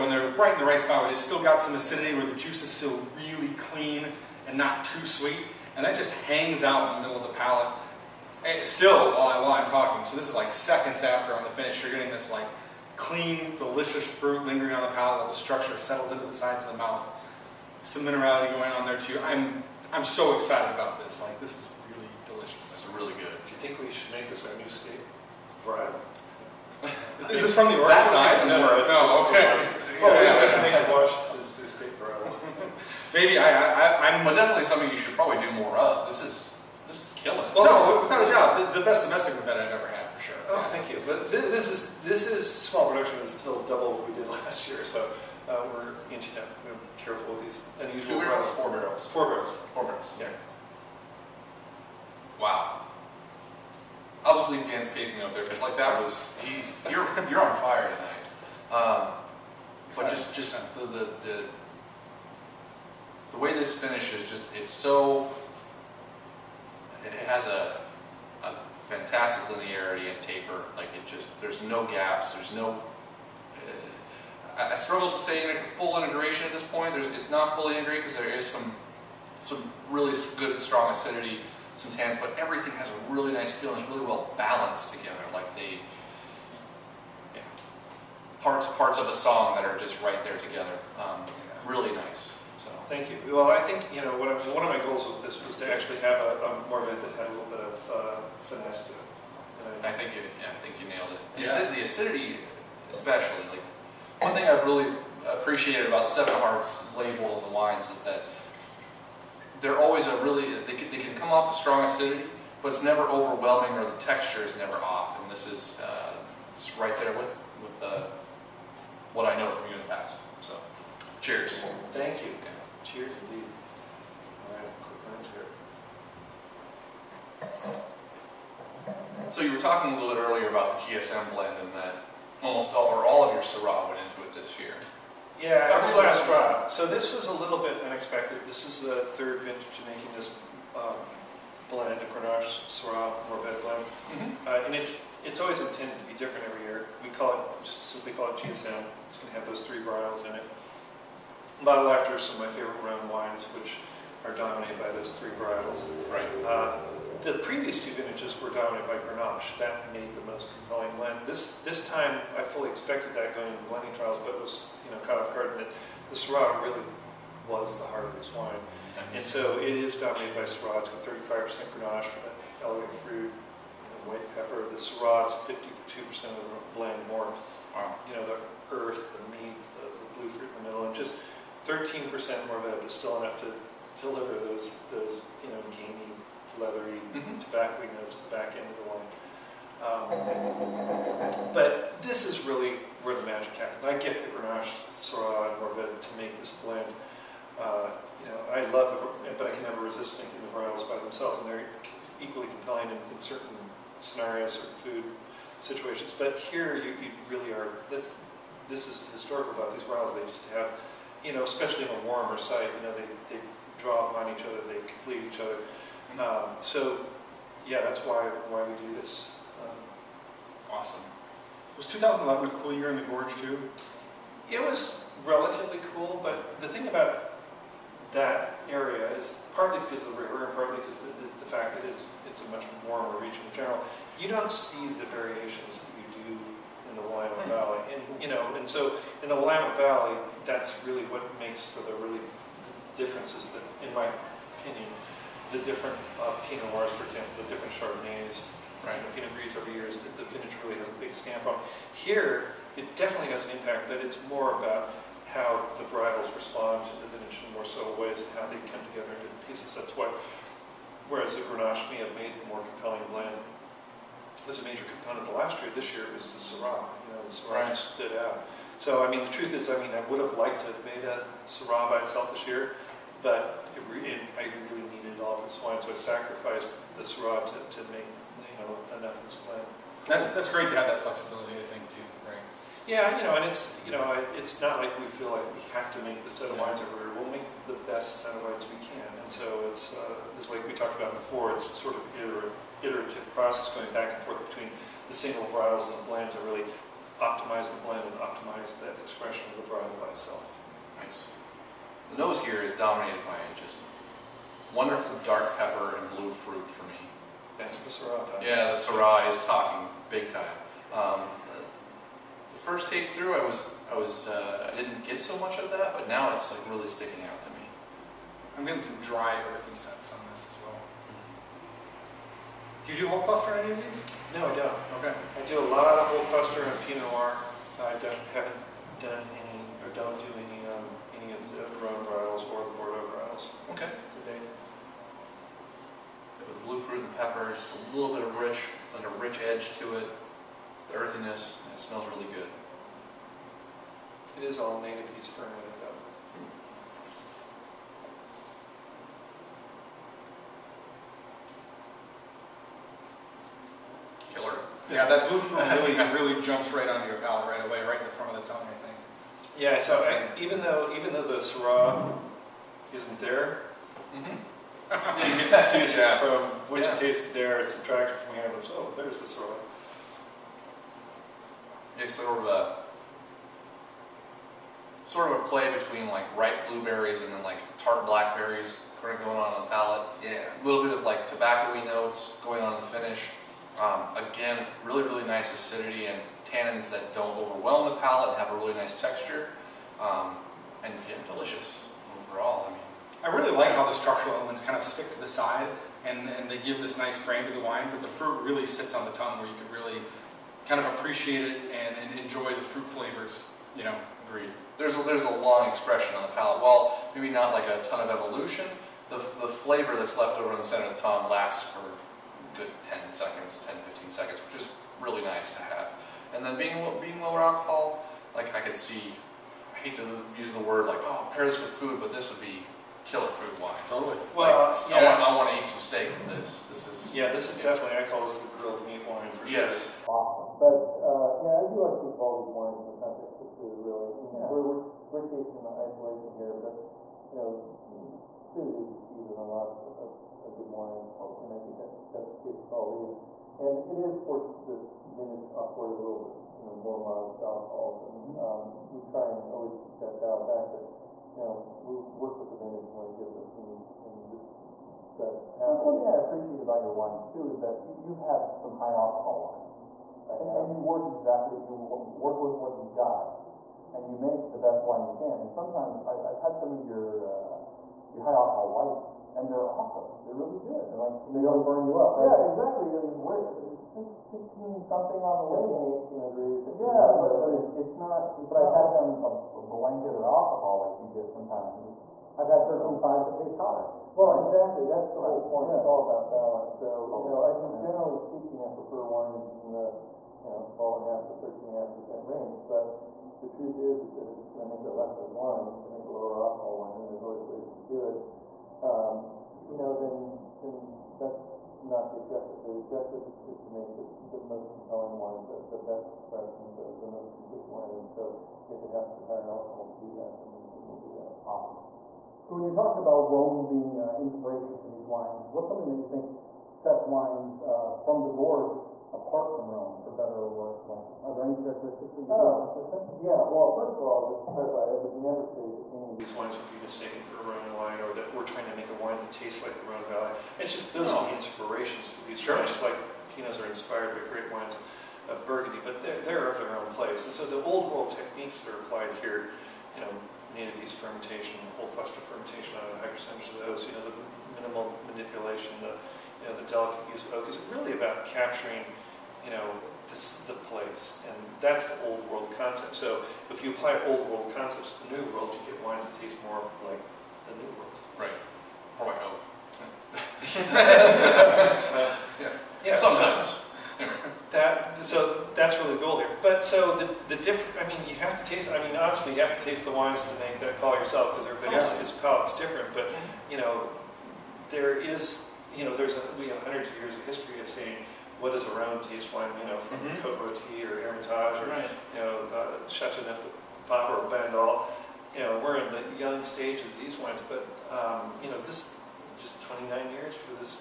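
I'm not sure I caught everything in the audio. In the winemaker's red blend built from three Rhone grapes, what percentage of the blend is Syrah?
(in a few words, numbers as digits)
52%.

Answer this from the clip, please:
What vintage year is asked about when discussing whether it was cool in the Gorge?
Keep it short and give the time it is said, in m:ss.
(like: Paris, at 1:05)
2011, at 3:41.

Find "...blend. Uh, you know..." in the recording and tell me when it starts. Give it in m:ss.
3:16.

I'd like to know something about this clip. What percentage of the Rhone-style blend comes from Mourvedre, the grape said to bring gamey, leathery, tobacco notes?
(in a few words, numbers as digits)
13%.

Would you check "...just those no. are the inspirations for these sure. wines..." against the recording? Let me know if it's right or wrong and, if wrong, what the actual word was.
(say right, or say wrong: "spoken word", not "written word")
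right.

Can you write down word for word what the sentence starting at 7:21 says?
and I think that that's the case with all these.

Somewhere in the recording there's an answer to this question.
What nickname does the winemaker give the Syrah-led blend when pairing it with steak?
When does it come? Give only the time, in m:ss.
7:08.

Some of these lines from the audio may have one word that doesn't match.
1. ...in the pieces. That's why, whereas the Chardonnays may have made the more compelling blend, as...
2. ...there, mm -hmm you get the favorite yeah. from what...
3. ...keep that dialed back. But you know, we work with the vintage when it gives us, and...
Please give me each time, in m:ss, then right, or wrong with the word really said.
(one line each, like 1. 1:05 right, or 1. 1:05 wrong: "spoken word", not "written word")
1. 4:19 wrong: "Grenache", not "Chardonnays"
2. 6:03 wrong: "taste", not "favorite"
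3. 7:29 right.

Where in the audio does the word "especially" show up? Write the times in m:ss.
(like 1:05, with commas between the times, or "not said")
1:42, 3:31.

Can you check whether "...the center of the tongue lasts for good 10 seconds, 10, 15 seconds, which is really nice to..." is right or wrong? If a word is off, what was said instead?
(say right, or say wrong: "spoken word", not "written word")
right.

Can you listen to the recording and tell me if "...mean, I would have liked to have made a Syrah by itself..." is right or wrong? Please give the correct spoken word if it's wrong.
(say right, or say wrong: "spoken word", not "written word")
right.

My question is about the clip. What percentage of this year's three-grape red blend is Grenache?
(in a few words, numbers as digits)
35%.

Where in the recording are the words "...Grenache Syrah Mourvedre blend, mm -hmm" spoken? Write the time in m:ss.
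2:22.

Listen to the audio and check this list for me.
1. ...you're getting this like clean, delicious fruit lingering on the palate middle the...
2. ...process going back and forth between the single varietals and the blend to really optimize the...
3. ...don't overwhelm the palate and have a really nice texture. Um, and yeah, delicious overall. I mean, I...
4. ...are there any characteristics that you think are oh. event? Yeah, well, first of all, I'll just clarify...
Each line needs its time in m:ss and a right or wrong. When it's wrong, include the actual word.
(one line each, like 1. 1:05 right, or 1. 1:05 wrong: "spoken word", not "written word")
1. 0:11 wrong: "while", not "middle"
2. 4:53 right
3. 6:27 right
4. 8:41 wrong: "consistent", not "event".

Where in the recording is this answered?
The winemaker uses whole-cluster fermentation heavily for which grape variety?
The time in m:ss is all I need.
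5:26.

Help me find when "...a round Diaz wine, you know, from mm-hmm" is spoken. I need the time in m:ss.
9:38.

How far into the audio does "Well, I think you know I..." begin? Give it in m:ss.
1:33.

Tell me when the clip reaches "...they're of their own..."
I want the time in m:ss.
8:56.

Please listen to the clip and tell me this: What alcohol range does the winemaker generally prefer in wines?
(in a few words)
12.5 to 13.5%.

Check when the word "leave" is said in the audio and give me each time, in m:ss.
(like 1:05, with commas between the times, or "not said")
0:54.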